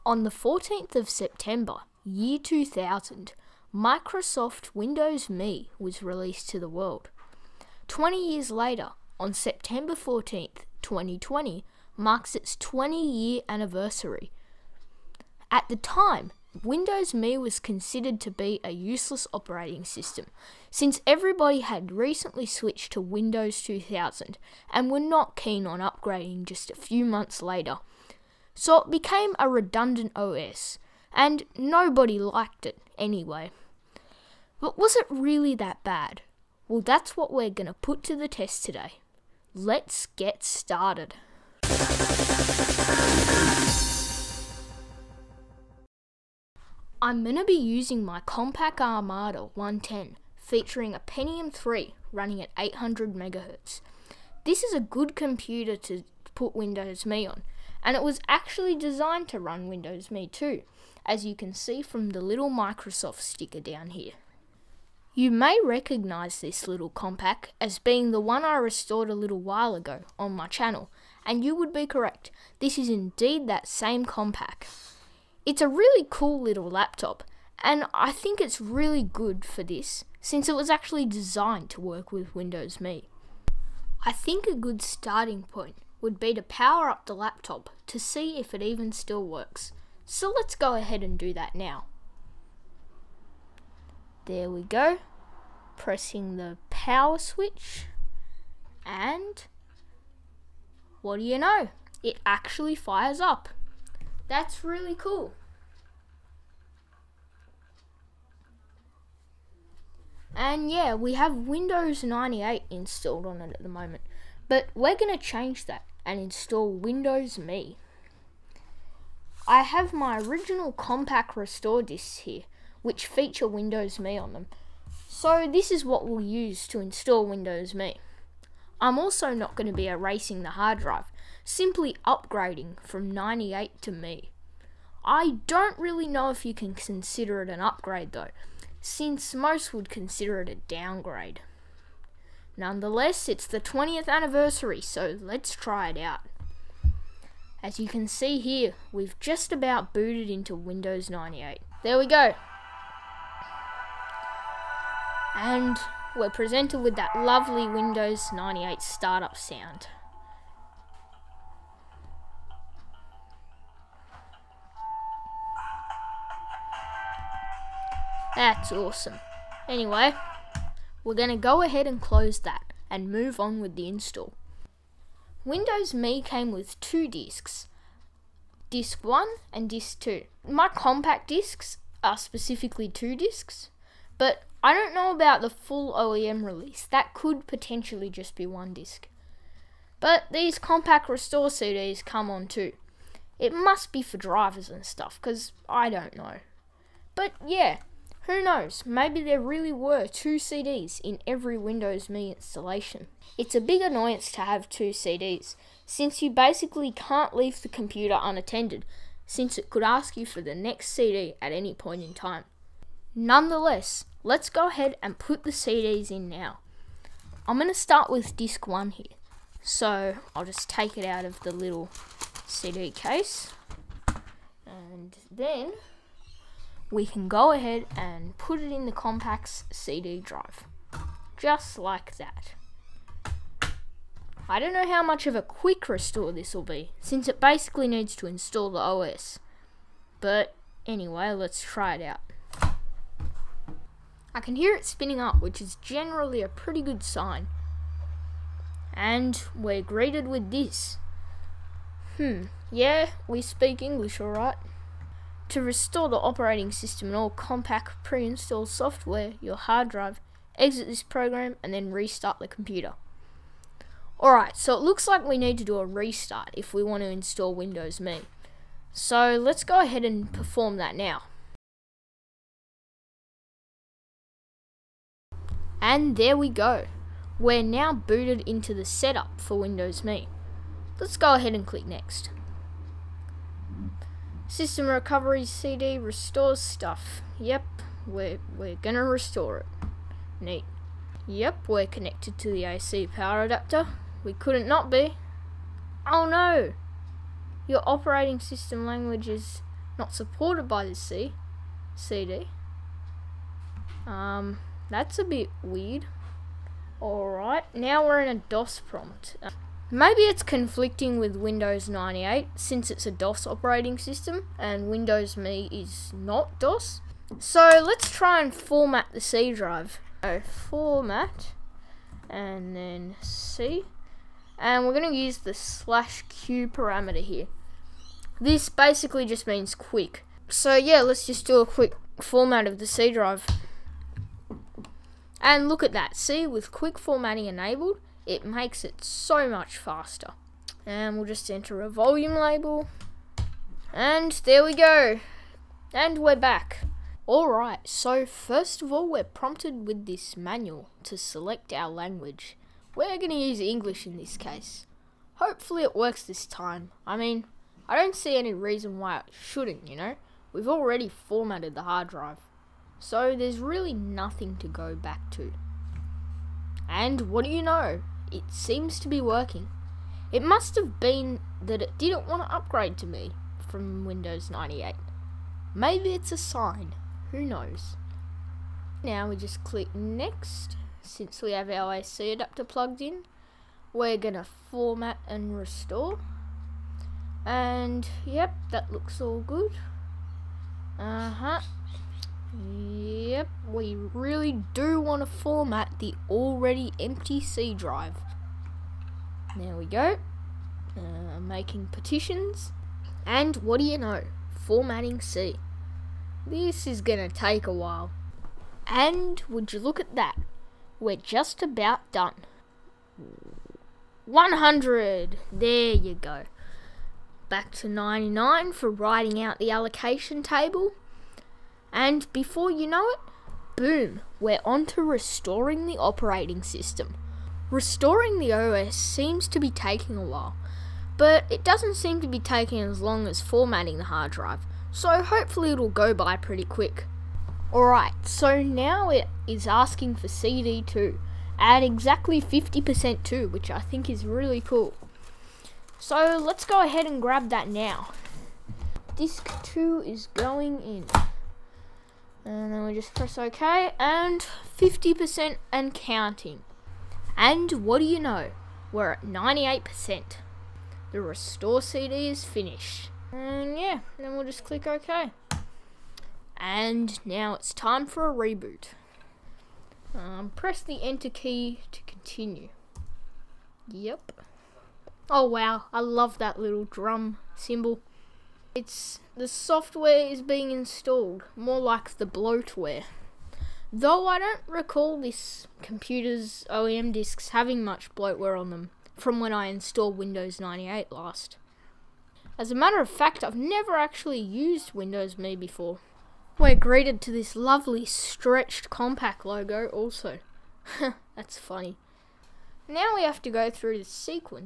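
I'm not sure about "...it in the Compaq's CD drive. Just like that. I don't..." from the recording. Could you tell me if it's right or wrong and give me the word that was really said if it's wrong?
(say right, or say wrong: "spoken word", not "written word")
right.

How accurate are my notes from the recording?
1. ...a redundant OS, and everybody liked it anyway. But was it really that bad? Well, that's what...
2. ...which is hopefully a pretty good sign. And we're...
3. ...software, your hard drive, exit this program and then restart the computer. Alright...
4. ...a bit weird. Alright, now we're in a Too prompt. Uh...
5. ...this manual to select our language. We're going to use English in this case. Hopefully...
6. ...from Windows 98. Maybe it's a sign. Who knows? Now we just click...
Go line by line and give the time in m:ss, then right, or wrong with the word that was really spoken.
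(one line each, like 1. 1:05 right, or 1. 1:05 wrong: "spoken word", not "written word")
1. 0:29 wrong: "nobody", not "everybody"
2. 4:05 wrong: "generally", not "hopefully"
3. 4:18 right
4. 5:05 wrong: "DOS", not "Too"
5. 5:50 right
6. 6:13 right.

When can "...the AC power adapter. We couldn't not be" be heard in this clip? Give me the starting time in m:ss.
4:52.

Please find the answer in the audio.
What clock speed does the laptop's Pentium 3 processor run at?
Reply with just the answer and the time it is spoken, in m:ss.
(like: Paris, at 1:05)
800 MHz, at 0:52.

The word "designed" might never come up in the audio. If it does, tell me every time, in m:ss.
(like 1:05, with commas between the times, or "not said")
0:58, 1:21.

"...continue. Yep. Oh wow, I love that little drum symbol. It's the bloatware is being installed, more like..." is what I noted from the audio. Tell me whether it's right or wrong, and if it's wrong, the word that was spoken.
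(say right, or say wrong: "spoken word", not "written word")
wrong: "software", not "bloatware".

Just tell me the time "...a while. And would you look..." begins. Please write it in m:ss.
6:47.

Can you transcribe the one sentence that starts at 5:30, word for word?
So yeah, let's just do a quick format of the C drive.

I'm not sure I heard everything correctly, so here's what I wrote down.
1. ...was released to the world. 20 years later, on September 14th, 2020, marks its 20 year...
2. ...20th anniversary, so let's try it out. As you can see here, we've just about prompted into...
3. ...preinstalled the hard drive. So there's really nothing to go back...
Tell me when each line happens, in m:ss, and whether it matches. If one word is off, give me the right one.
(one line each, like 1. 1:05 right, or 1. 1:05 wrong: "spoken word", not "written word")
1. 0:05 right
2. 2:23 wrong: "booted", not "prompted"
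3. 6:01 wrong: "formatted", not "preinstalled".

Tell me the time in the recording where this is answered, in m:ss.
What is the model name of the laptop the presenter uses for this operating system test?
0:48.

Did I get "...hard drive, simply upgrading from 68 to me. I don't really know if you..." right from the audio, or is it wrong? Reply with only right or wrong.
wrong.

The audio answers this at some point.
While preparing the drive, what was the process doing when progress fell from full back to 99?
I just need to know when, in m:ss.
6:58.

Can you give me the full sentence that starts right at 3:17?
But yeah, who knows, maybe there really were two CDs in every Windows Me installation.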